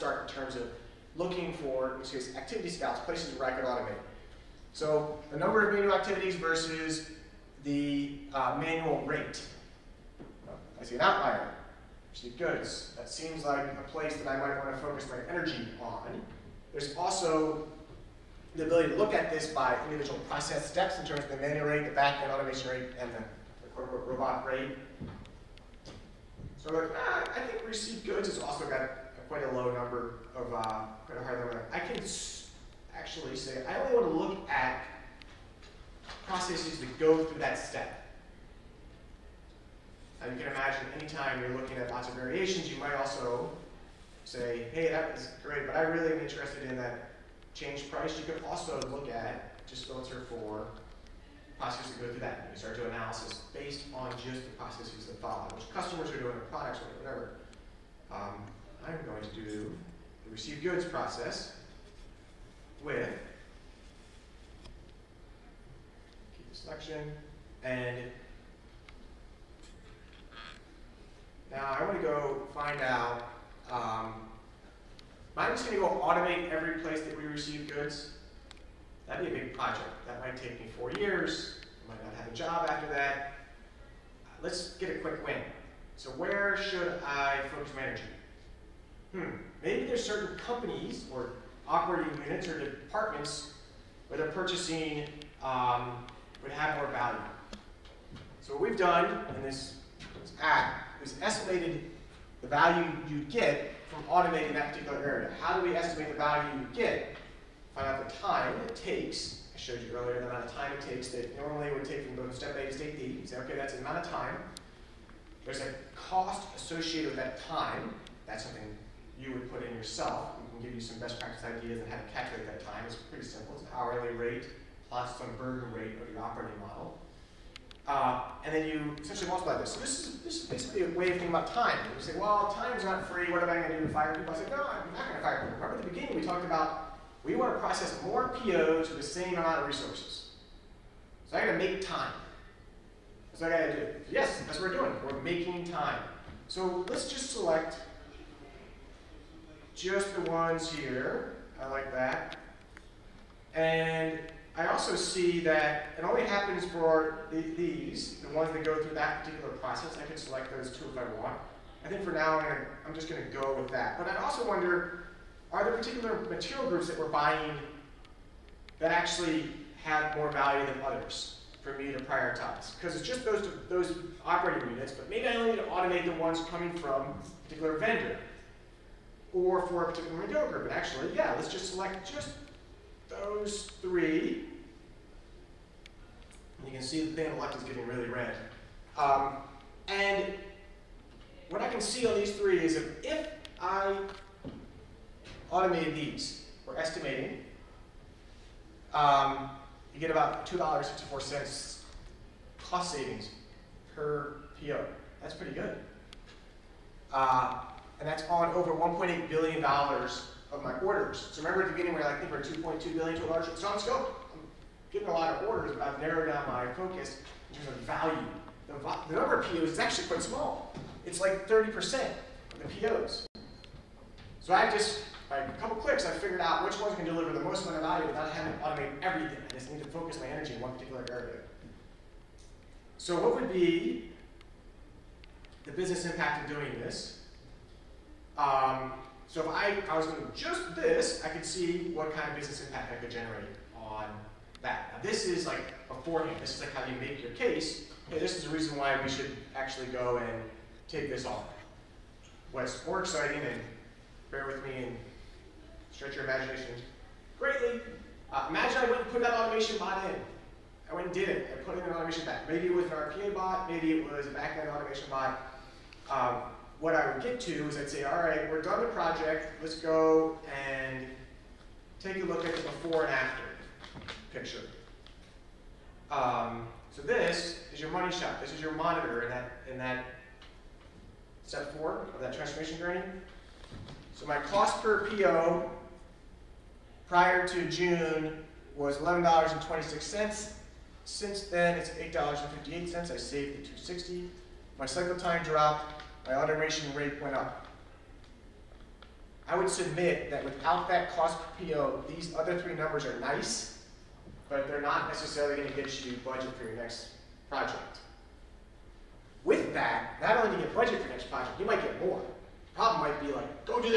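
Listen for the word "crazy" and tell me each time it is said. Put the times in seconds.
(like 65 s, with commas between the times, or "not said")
not said.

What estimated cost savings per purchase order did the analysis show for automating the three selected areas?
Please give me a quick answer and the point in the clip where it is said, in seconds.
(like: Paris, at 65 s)
$2.64, at 200 s.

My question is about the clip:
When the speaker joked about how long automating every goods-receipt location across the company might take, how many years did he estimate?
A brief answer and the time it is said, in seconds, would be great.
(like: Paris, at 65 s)
4 years, at 80 s.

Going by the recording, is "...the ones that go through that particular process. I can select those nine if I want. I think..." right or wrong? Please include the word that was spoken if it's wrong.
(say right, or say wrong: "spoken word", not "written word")
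wrong: "two", not "nine".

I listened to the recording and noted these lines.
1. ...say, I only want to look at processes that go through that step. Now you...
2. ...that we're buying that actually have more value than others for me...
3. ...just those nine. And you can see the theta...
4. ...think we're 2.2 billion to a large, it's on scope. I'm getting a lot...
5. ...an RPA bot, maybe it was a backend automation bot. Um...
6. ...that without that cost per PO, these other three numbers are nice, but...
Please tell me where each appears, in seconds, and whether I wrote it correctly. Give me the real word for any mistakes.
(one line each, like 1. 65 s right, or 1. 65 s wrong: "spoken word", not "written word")
1. 33 s right
2. 166 s right
3. 182 s wrong: "three", not "nine"
4. 212 s right
5. 262 s right
6. 300 s right.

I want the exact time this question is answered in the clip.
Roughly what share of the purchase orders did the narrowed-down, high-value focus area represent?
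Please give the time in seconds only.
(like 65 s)
221 s.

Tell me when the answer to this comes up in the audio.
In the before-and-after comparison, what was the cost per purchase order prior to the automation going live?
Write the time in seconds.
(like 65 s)
288 s.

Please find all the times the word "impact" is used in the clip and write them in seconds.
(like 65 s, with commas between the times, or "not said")
236 s, 242 s.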